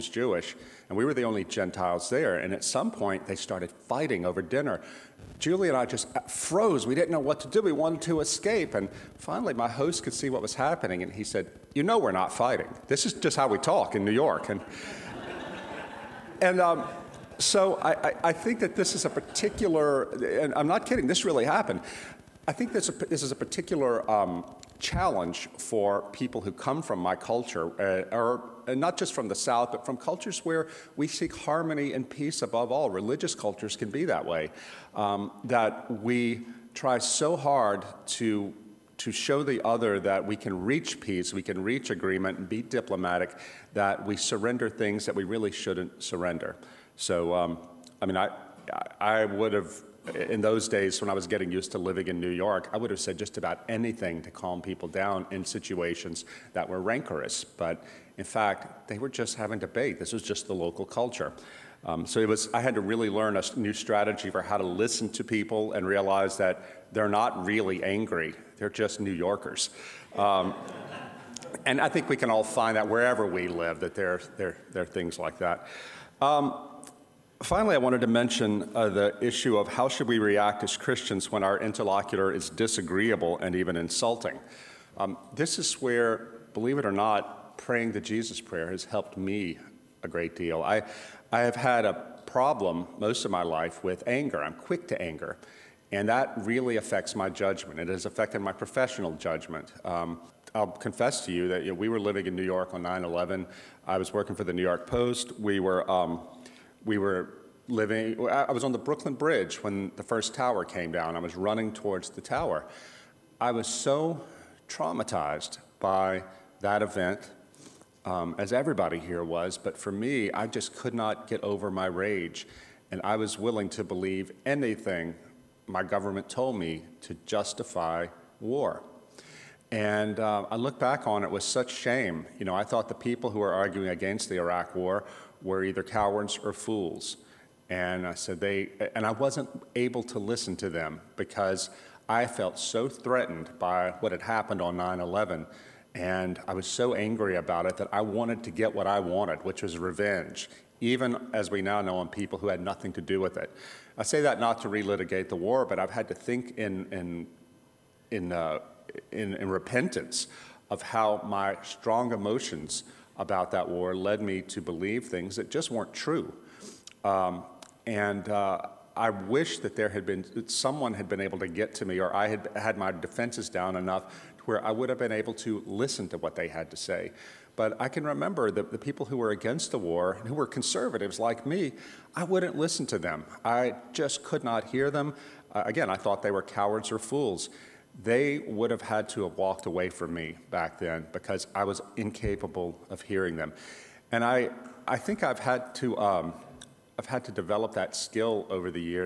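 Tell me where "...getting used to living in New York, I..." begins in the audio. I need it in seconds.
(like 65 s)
51 s.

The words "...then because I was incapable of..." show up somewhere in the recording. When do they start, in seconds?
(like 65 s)
190 s.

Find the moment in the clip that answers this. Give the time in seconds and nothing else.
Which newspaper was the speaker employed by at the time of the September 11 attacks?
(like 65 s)
104 s.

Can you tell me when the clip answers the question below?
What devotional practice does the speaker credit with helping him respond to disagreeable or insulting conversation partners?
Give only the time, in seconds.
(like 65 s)
87 s.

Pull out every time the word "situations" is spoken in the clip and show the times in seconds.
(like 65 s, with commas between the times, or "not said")
55 s.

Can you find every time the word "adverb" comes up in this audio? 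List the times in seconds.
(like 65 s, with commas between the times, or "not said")
not said.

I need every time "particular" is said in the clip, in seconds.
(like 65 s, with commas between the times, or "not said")
19 s, 23 s.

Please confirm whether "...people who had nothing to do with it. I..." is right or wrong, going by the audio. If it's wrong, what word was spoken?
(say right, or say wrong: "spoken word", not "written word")
right.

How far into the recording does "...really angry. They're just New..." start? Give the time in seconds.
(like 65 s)
67 s.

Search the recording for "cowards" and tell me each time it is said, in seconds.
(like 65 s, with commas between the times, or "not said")
135 s, 186 s.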